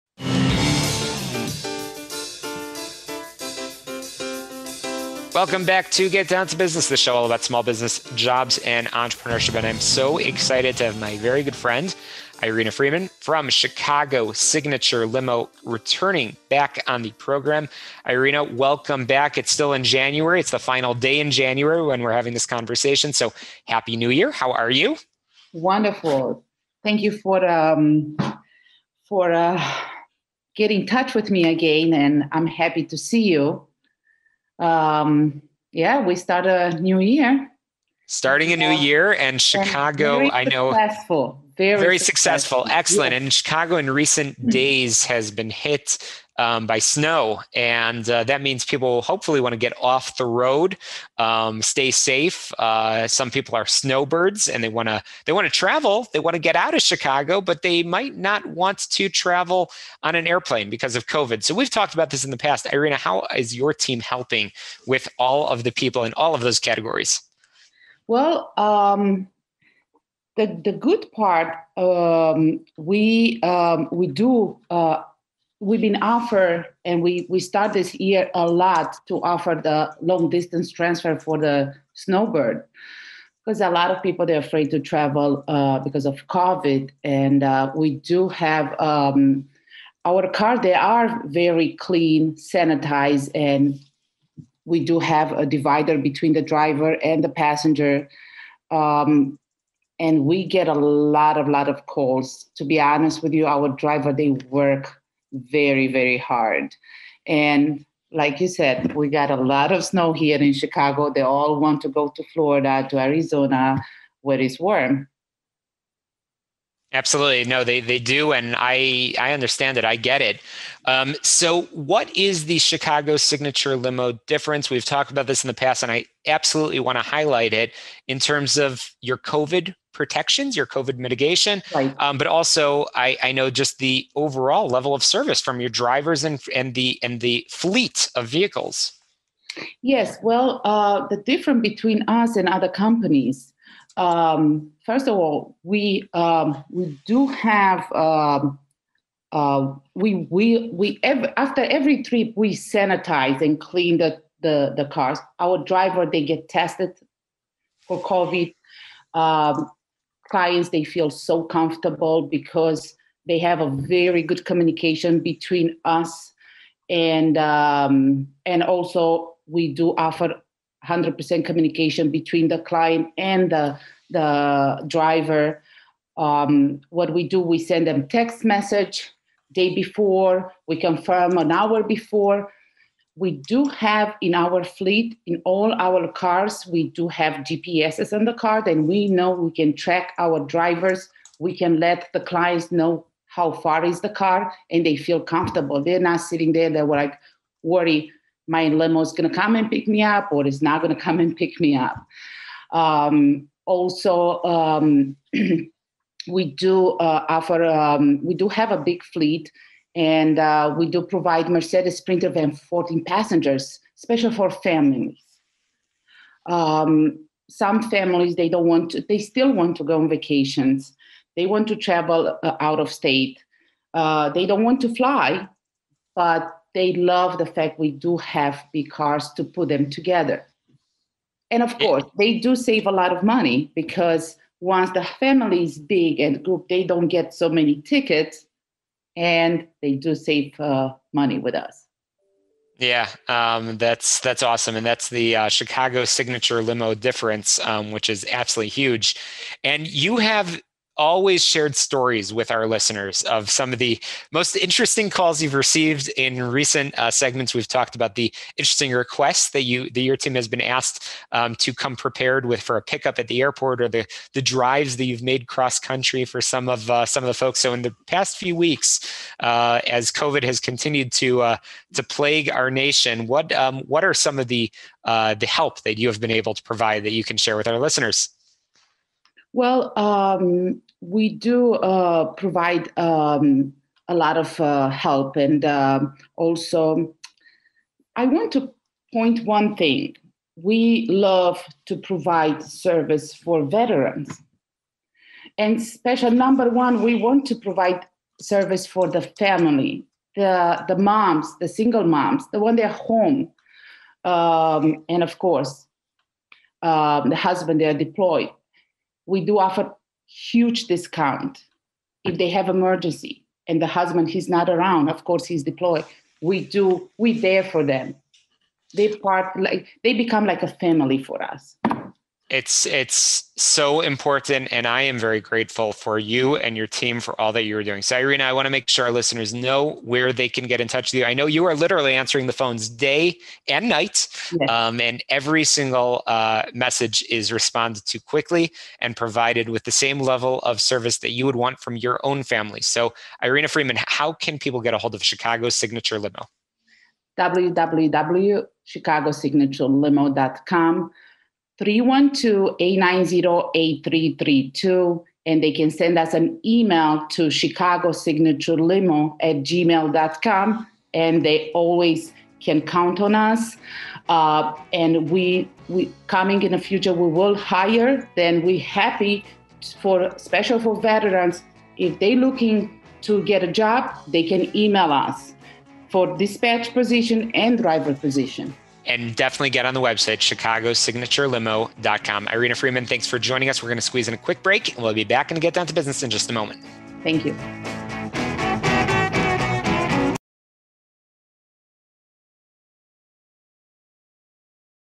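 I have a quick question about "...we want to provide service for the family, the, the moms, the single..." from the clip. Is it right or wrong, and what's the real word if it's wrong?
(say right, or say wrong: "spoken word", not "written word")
right.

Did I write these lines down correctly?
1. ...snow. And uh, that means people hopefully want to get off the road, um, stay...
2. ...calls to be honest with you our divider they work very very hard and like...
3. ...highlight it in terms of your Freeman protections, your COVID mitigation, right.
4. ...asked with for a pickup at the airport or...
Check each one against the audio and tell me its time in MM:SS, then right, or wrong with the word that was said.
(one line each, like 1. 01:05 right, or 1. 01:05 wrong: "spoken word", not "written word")
1. 00:46 right
2. 01:41 wrong: "driver", not "divider"
3. 02:07 wrong: "COVID", not "Freeman"
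4. 04:21 wrong: "prepared", not "asked".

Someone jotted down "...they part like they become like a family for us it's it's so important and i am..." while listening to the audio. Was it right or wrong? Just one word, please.
right.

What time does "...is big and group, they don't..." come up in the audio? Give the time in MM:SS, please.
03:55.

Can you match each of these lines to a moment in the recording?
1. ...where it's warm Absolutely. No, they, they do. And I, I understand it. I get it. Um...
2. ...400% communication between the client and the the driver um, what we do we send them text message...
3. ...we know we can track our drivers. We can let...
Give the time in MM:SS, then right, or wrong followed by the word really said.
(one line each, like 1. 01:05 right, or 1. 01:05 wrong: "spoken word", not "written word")
1. 01:54 right
2. 02:50 wrong: "100", not "400"
3. 03:08 right.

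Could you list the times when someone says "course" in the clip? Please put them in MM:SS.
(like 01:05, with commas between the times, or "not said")
03:51, 05:05, 05:15.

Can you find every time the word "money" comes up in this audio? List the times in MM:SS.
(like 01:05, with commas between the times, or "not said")
03:53, 04:01.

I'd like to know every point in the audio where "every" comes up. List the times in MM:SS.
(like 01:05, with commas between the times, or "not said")
02:31, 05:35.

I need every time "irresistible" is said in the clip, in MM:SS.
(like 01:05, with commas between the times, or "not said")
not said.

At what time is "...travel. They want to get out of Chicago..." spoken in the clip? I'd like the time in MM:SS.
00:55.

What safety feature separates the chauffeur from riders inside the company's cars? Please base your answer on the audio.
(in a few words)
A divider.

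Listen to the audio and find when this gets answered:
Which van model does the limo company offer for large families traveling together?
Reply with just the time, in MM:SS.
03:31.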